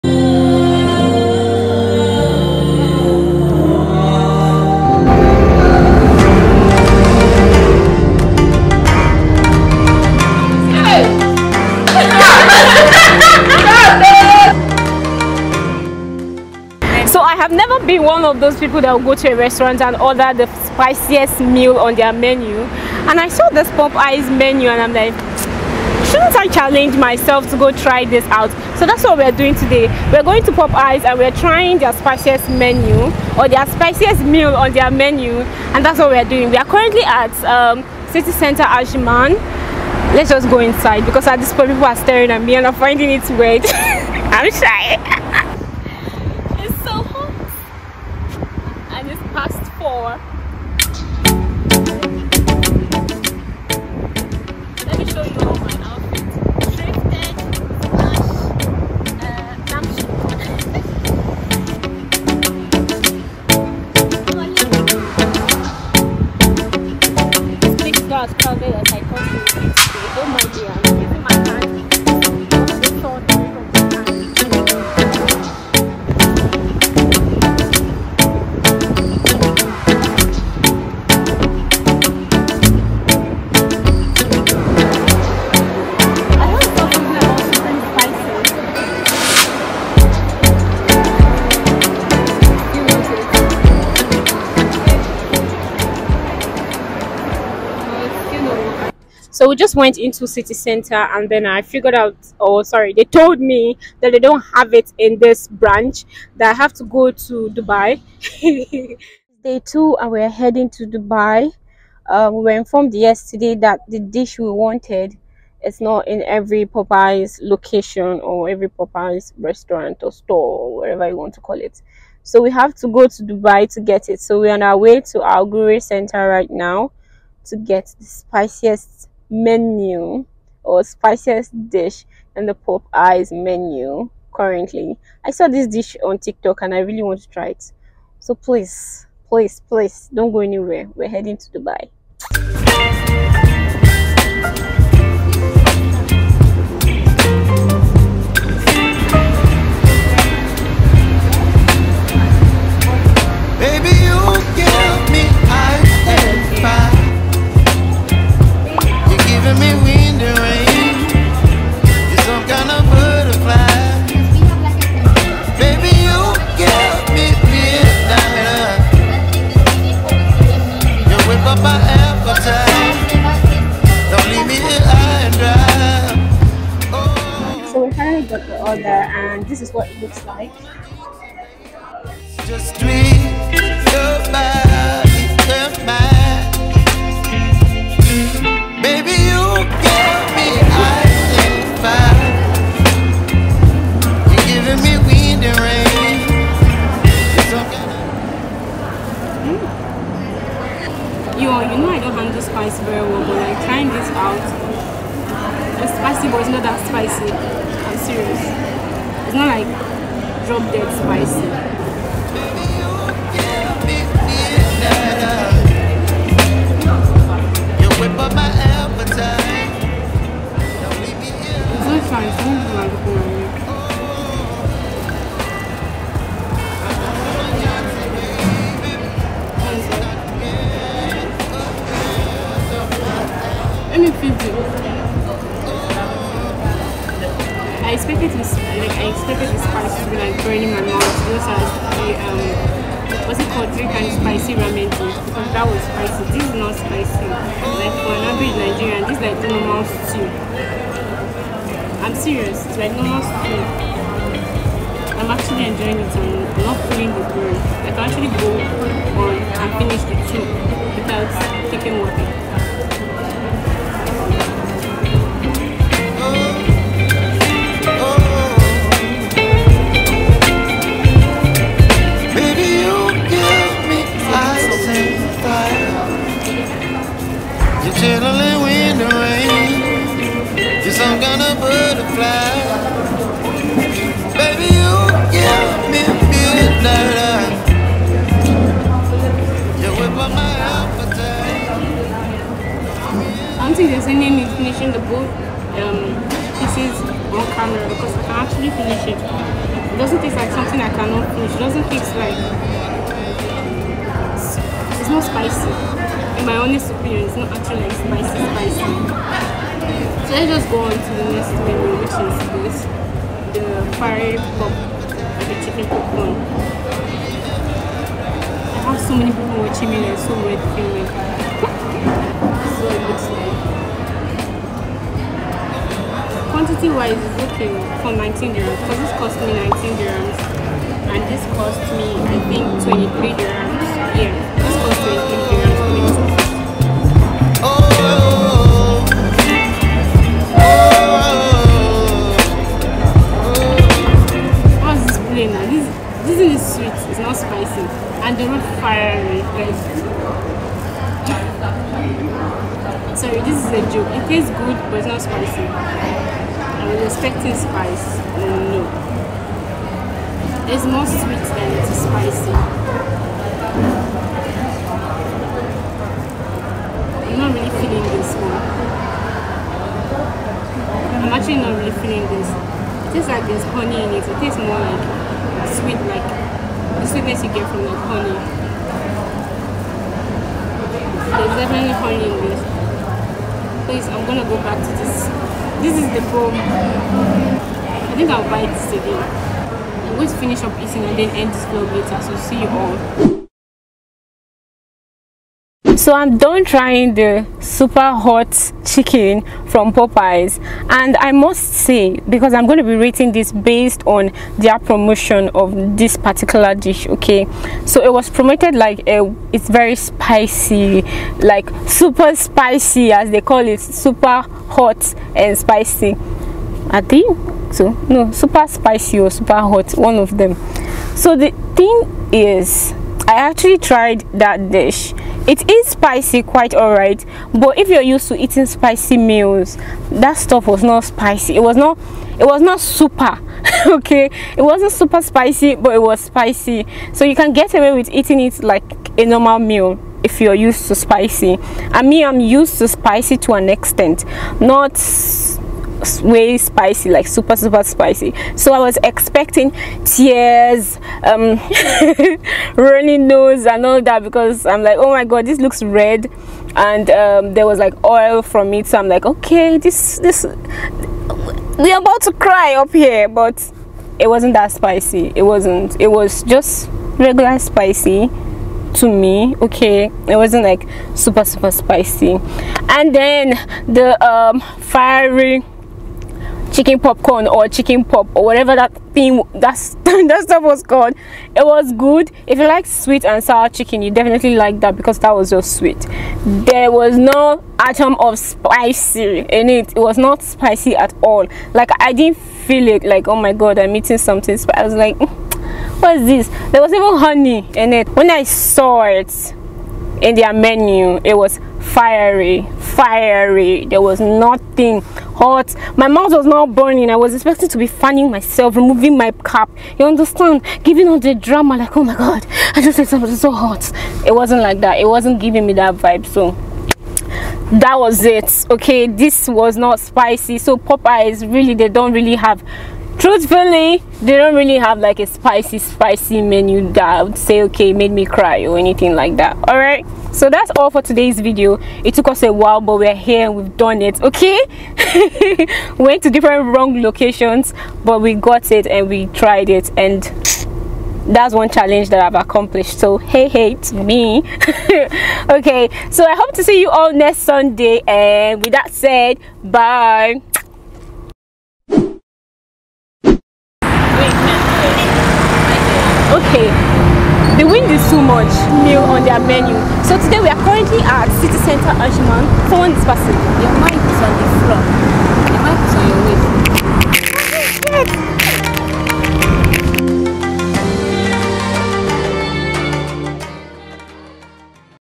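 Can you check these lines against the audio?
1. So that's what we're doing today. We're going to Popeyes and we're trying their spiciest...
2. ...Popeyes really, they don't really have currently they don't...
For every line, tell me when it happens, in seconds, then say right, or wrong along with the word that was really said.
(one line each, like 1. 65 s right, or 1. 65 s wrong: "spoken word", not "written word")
1. 28 s right
2. 520 s wrong: "truthfully", not "currently".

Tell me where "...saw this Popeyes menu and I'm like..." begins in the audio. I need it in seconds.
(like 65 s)
23 s.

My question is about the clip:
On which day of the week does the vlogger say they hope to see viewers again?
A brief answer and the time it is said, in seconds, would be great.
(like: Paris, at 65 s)
Sunday, at 547 s.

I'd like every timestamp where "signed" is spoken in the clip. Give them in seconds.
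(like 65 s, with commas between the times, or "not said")
not said.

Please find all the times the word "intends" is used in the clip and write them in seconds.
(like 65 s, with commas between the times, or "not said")
not said.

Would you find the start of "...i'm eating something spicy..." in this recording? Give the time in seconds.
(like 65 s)
493 s.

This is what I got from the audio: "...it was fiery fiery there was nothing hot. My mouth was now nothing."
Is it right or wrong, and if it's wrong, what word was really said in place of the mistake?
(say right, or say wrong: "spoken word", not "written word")
wrong: "burning", not "nothing".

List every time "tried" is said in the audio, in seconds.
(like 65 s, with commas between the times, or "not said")
423 s, 539 s.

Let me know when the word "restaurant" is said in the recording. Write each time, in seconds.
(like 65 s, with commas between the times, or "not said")
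19 s, 119 s.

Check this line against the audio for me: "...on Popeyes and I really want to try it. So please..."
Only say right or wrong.
wrong.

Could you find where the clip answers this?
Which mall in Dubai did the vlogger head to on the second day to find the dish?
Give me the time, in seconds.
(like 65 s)
125 s.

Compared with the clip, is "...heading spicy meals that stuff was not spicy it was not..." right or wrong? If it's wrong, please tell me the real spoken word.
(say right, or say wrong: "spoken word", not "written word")
wrong: "eating", not "heading".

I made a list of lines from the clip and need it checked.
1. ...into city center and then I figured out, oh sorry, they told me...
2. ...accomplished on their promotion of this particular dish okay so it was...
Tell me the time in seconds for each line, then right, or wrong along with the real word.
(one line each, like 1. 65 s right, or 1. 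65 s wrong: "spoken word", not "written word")
1. 99 s right
2. 403 s wrong: "based", not "accomplished".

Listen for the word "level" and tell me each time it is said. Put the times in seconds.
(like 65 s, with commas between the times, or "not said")
not said.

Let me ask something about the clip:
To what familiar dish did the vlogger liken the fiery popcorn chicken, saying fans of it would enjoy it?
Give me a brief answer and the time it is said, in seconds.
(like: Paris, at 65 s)
sweet and sour chicken, at 482 s.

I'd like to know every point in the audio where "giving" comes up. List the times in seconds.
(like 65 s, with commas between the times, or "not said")
510 s, 515 s.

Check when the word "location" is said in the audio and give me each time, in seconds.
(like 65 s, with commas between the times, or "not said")
117 s, 537 s.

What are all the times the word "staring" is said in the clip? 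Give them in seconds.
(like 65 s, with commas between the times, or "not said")
41 s.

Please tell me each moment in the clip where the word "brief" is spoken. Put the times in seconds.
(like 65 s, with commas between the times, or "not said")
not said.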